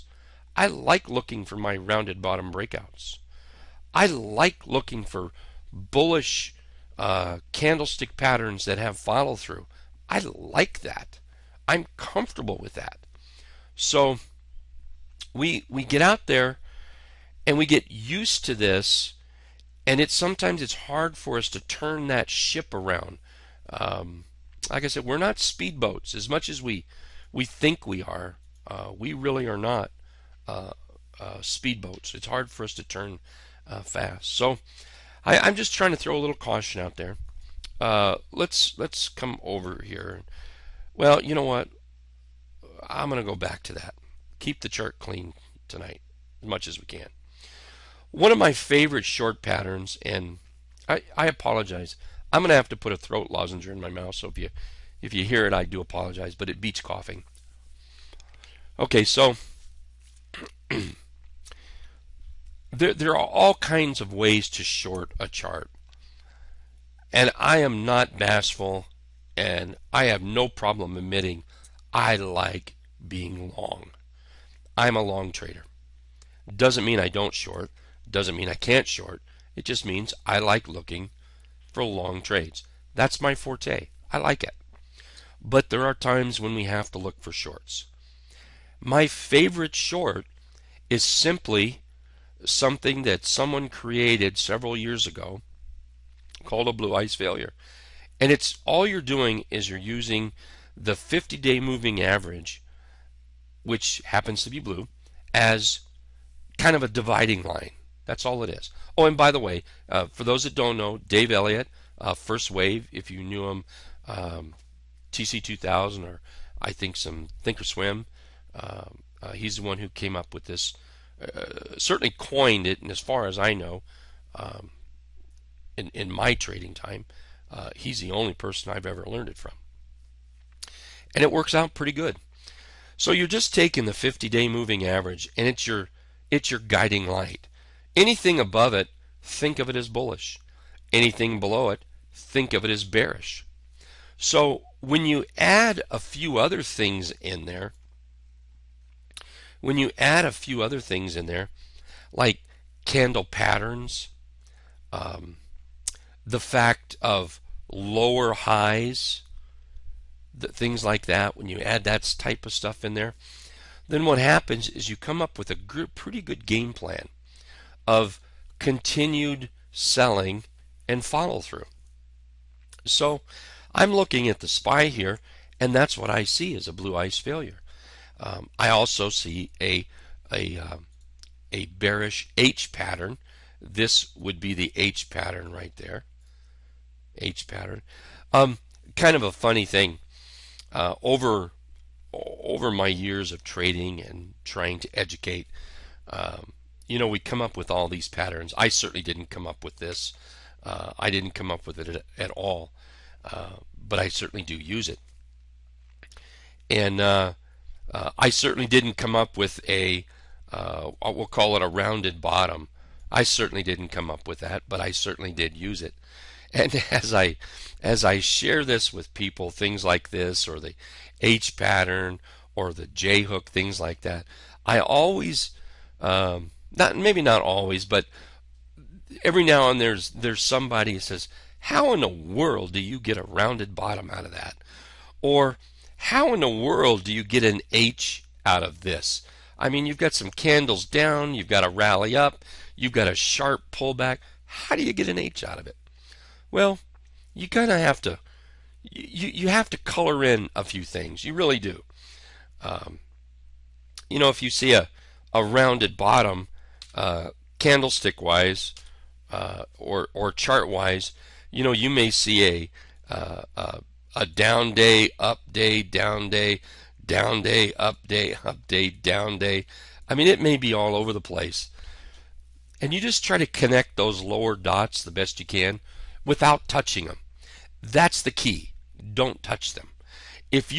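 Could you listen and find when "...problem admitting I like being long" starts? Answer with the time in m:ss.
1:10.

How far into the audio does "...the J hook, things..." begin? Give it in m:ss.
3:42.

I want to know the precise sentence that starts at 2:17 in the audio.
Anything above it, think of it as bullish.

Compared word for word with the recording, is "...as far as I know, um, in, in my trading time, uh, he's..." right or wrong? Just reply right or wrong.
right.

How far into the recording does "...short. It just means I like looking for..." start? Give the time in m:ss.
1:18.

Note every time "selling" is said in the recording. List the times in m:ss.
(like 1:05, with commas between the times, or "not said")
2:49.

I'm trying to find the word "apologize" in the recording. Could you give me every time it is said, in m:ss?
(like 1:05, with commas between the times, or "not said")
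0:51, 0:55.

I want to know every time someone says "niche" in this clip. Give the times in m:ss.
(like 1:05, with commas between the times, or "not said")
not said.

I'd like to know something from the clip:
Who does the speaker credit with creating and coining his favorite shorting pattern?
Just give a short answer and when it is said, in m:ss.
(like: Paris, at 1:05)
Dave Elliott, at 1:50.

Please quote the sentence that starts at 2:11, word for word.
And it works out pretty good.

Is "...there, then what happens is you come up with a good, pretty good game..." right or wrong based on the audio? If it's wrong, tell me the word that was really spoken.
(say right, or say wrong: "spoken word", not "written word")
right.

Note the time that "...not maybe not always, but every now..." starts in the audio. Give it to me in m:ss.
3:46.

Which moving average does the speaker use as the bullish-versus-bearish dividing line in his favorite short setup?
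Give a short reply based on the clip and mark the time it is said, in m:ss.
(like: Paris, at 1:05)
50-day moving average, at 1:40.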